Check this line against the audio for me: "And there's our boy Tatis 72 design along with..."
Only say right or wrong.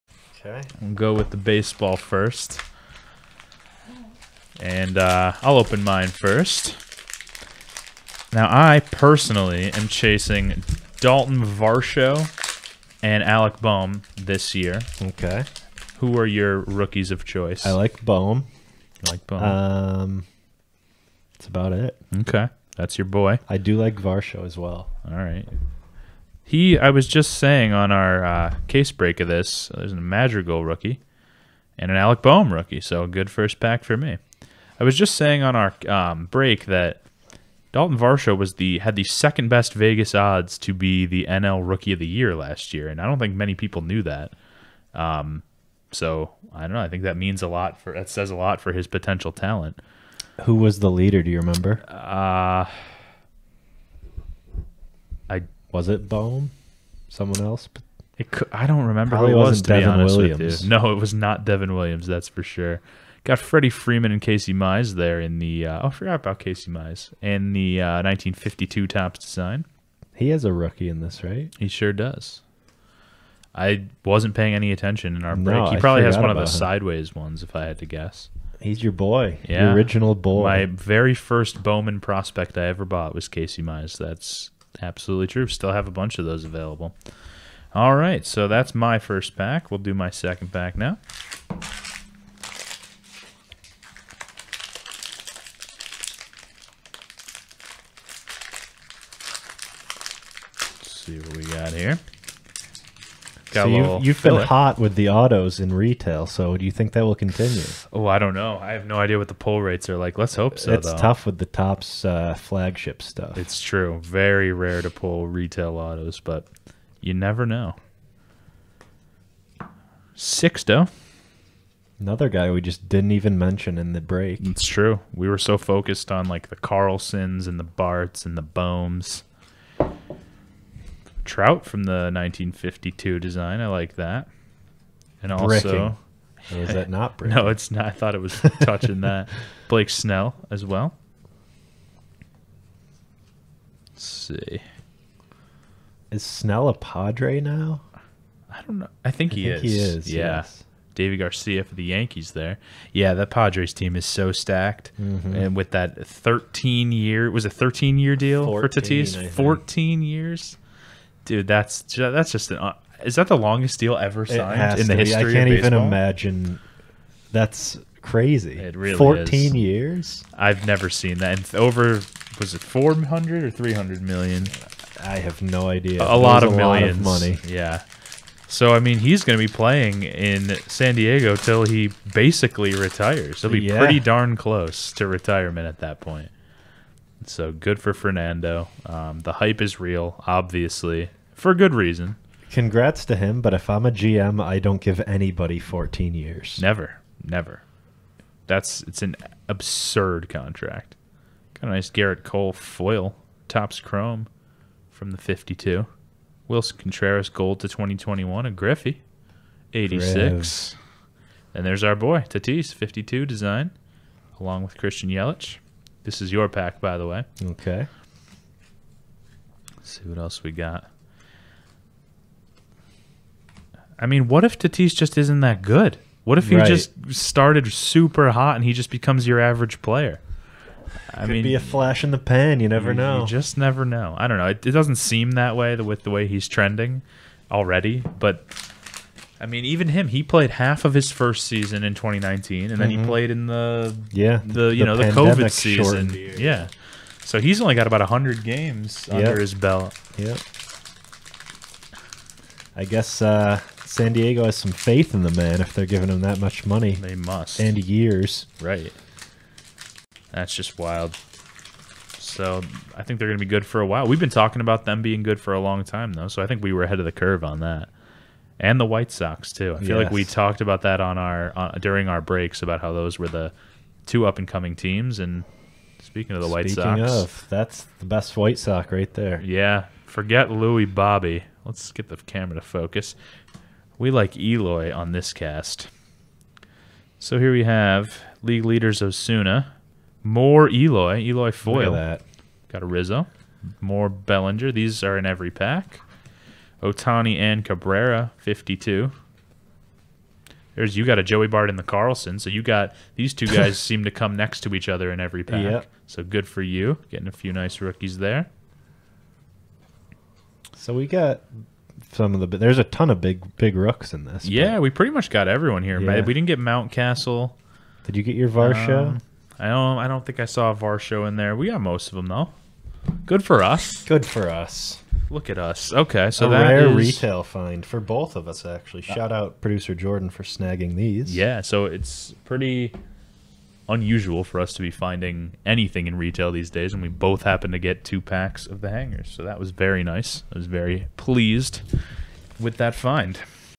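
wrong.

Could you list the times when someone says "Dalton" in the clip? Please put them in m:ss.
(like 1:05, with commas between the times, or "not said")
0:10, 0:37.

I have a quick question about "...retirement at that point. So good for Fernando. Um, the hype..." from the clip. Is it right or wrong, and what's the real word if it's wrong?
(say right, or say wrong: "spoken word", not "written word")
right.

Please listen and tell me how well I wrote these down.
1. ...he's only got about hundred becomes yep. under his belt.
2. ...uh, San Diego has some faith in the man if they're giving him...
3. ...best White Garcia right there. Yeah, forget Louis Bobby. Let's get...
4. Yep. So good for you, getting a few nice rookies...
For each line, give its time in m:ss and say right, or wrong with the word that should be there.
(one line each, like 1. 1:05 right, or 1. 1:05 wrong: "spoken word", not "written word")
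1. 4:07 wrong: "games", not "becomes"
2. 4:13 right
3. 4:38 wrong: "Sox", not "Garcia"
4. 5:05 right.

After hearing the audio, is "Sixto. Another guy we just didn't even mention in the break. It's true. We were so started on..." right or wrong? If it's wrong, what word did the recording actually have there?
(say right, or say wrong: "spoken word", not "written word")
wrong: "focused", not "started".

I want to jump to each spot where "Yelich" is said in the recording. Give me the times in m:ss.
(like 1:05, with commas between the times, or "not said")
3:35.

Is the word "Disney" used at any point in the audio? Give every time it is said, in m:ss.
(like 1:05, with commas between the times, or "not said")
not said.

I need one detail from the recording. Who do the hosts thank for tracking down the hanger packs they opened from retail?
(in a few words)
Producer Jordan.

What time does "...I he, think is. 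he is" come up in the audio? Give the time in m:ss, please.
2:29.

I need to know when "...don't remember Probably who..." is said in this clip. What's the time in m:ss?
0:58.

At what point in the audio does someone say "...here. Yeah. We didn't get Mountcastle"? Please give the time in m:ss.
5:15.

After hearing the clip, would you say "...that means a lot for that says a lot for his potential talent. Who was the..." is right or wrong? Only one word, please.
right.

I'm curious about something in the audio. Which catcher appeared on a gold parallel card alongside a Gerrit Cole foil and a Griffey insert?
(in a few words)
Willson Contreras.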